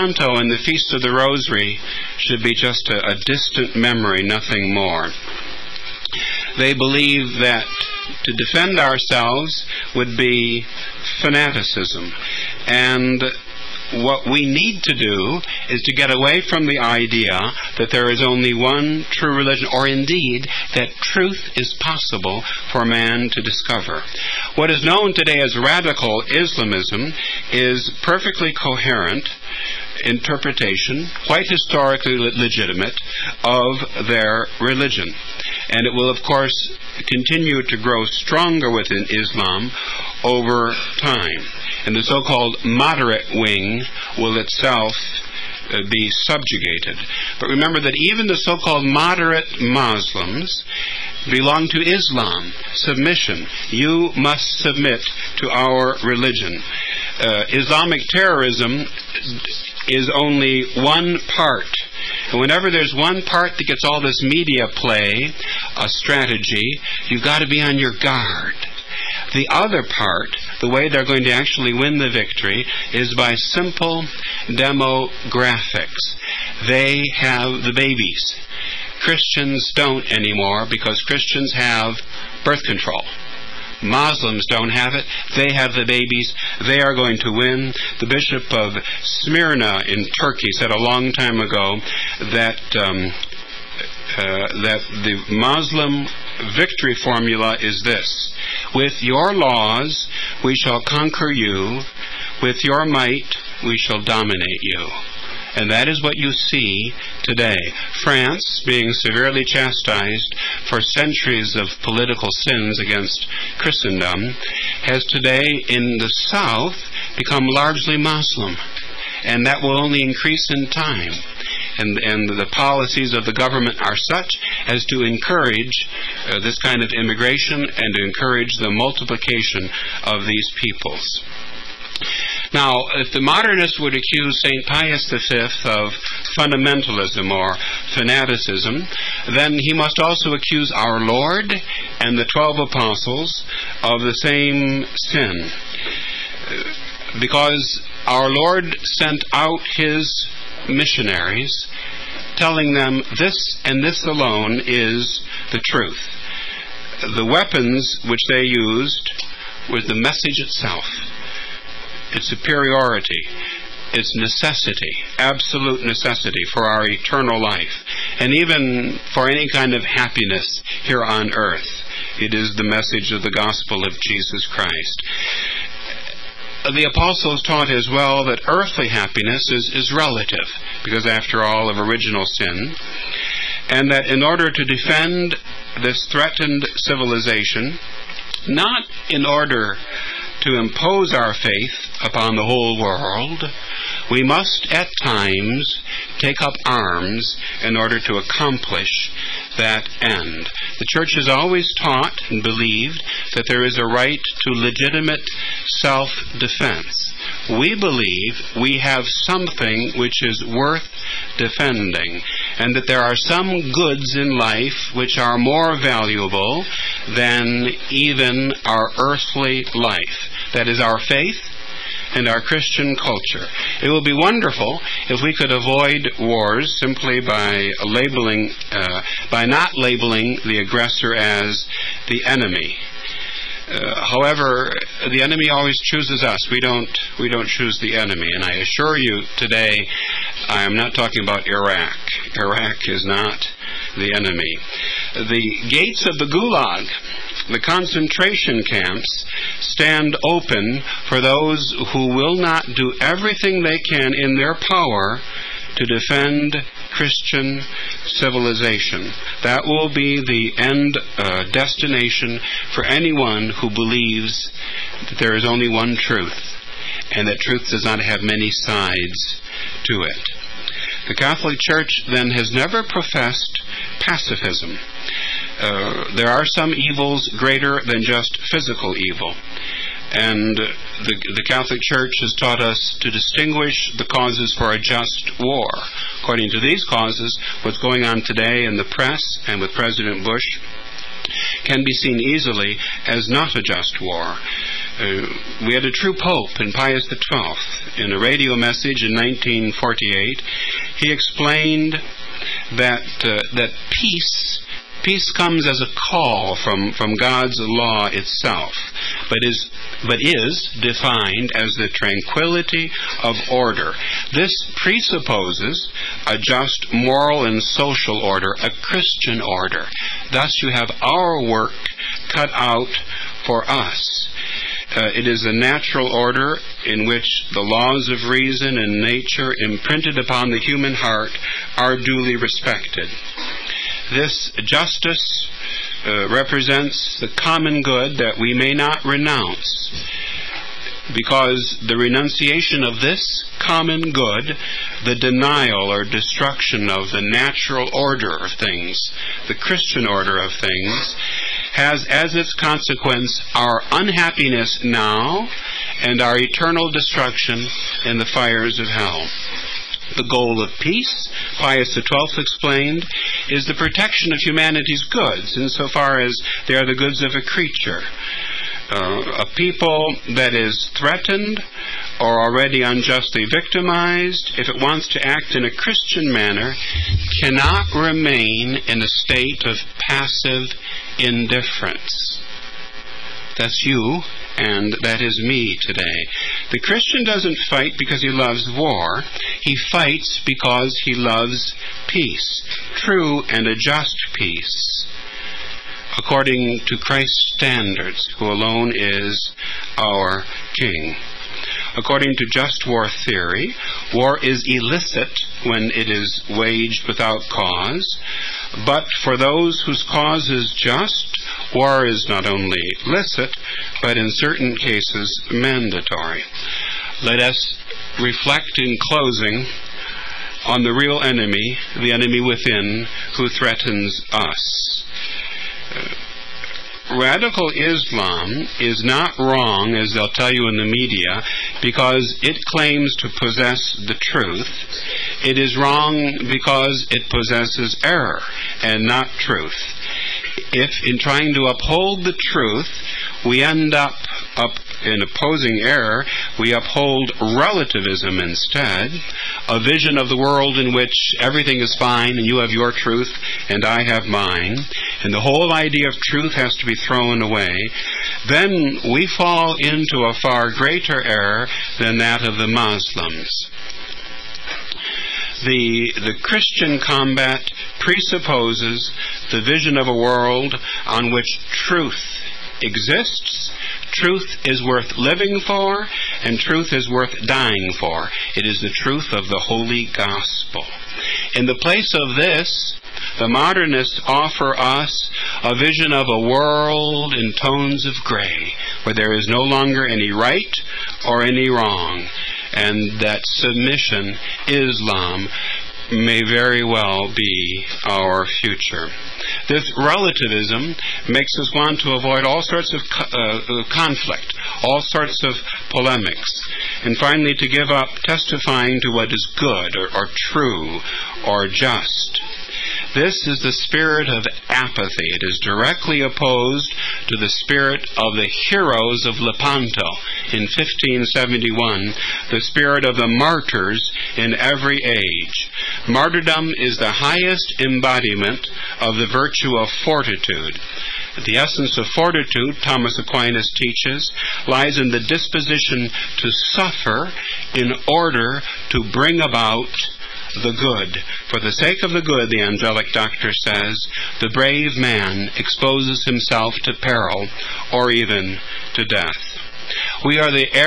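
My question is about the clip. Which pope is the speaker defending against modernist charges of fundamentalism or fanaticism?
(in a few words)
St. Pius V.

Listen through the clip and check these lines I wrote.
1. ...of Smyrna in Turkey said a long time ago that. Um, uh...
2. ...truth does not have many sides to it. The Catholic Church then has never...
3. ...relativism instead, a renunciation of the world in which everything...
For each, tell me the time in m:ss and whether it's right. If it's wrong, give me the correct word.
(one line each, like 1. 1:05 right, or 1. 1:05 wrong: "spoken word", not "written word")
1. 1:28 right
2. 4:27 right
3. 7:27 wrong: "vision", not "renunciation".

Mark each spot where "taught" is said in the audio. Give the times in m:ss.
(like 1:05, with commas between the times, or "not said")
2:57, 3:21, 4:42.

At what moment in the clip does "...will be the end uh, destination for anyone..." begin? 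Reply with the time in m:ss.
4:19.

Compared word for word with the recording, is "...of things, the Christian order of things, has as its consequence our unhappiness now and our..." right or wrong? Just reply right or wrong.
right.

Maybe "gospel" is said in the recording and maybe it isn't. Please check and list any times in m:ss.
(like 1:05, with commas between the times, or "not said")
2:53, 8:00.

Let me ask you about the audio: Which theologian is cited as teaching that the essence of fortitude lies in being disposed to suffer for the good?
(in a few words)
Thomas Aquinas.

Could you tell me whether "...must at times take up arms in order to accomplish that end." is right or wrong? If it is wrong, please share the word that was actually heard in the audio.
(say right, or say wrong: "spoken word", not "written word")
right.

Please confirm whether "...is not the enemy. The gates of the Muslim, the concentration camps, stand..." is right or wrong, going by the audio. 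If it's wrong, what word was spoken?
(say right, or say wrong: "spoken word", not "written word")
wrong: "Gulag", not "Muslim".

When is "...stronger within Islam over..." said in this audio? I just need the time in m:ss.
0:38.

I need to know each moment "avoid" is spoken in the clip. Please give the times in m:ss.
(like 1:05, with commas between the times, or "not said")
3:45, 8:22.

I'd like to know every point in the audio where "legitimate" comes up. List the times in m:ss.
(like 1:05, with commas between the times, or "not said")
0:32, 3:24.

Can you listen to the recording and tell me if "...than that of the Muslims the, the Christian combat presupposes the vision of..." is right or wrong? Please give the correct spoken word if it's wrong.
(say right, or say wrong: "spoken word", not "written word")
right.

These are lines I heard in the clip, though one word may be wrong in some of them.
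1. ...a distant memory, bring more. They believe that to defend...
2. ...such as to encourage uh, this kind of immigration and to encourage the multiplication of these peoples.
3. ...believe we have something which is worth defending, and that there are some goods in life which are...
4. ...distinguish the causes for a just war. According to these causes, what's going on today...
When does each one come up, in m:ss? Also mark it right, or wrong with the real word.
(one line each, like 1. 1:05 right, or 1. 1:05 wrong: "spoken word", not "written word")
1. 0:03 wrong: "nothing", not "bring"
2. 2:04 right
3. 3:27 right
4. 4:43 right.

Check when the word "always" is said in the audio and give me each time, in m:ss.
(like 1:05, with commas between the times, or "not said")
3:21, 3:55.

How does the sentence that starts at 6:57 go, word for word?
Let us reflect in closing on the real enemy, the enemy within, who threatens us.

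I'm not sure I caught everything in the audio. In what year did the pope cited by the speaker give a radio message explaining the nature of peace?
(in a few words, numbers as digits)
1948.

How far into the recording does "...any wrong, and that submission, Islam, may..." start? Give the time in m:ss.
8:11.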